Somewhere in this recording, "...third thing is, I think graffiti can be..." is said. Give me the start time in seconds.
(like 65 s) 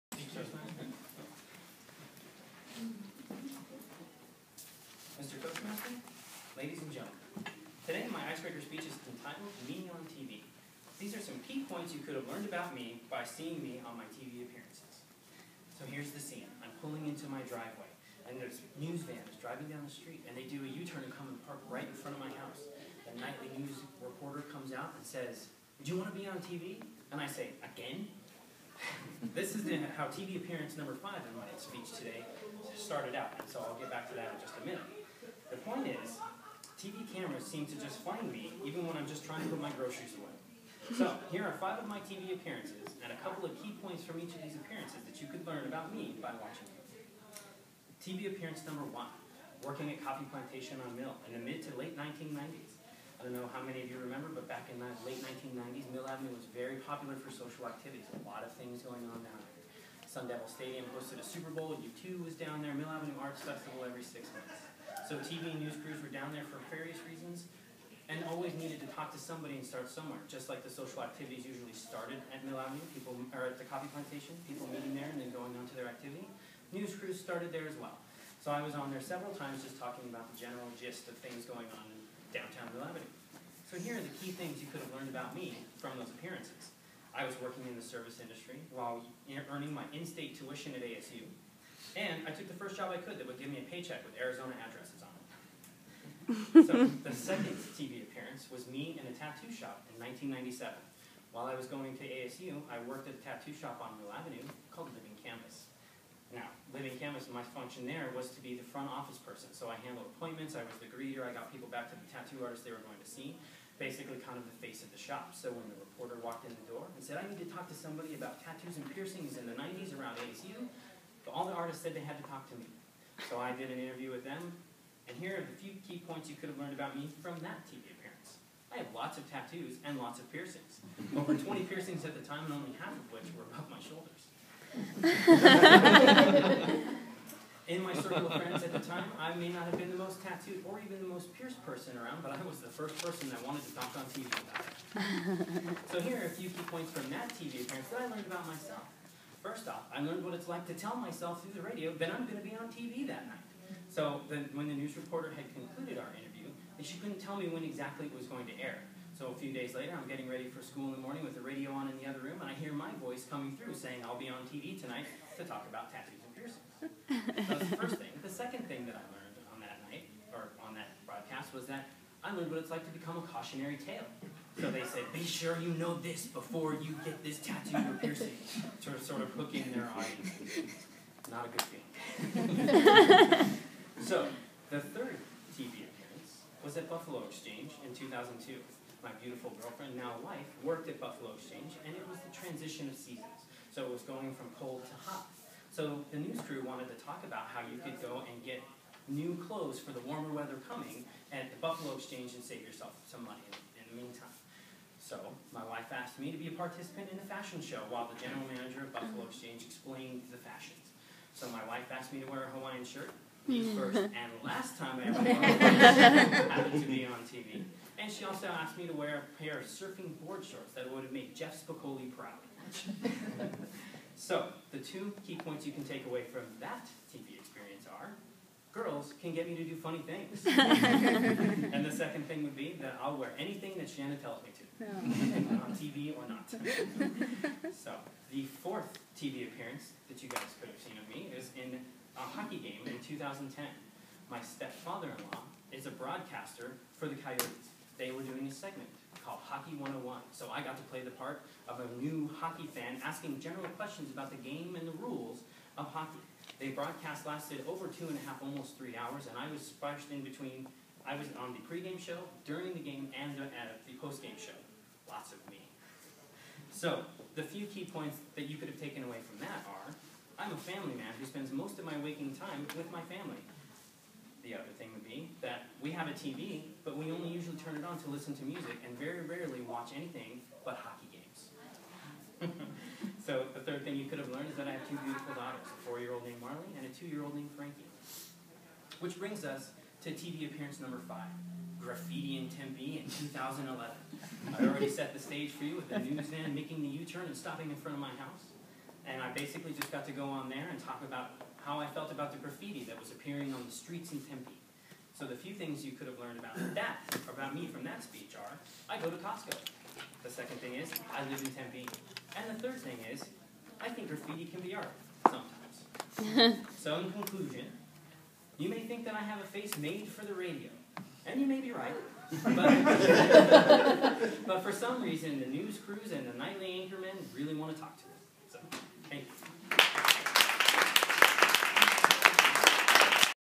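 312 s.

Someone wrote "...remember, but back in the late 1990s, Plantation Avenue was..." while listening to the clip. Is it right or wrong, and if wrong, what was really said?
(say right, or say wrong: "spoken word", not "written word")
wrong: "Mill", not "Plantation".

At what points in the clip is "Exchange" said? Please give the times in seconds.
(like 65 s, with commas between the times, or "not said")
187 s, 191 s, 201 s, 209 s.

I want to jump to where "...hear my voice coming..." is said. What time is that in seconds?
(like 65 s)
162 s.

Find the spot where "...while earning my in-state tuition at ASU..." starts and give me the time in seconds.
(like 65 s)
88 s.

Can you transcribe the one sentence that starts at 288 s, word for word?
Which brings us to TV appearance number five, graffiti in Tempe in 2011.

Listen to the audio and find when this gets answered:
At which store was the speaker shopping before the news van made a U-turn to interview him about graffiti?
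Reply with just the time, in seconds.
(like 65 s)
309 s.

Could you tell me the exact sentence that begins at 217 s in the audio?
And she also asked me to wear a pair of surfing board shorts that would have made Jeff Spicoli proud.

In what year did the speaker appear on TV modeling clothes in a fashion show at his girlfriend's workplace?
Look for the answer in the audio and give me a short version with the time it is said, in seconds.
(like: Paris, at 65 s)
2002, at 187 s.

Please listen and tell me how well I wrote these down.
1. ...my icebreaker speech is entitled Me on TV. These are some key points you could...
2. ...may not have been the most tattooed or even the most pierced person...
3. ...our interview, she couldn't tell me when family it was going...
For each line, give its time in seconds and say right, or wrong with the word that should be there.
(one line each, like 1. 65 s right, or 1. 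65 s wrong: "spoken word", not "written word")
1. 8 s right
2. 139 s right
3. 155 s wrong: "exactly", not "family".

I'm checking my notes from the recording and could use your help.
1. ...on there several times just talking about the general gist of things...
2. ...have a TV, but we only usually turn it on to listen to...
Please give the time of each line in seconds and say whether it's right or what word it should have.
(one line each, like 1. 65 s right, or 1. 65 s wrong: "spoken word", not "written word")
1. 78 s right
2. 275 s right.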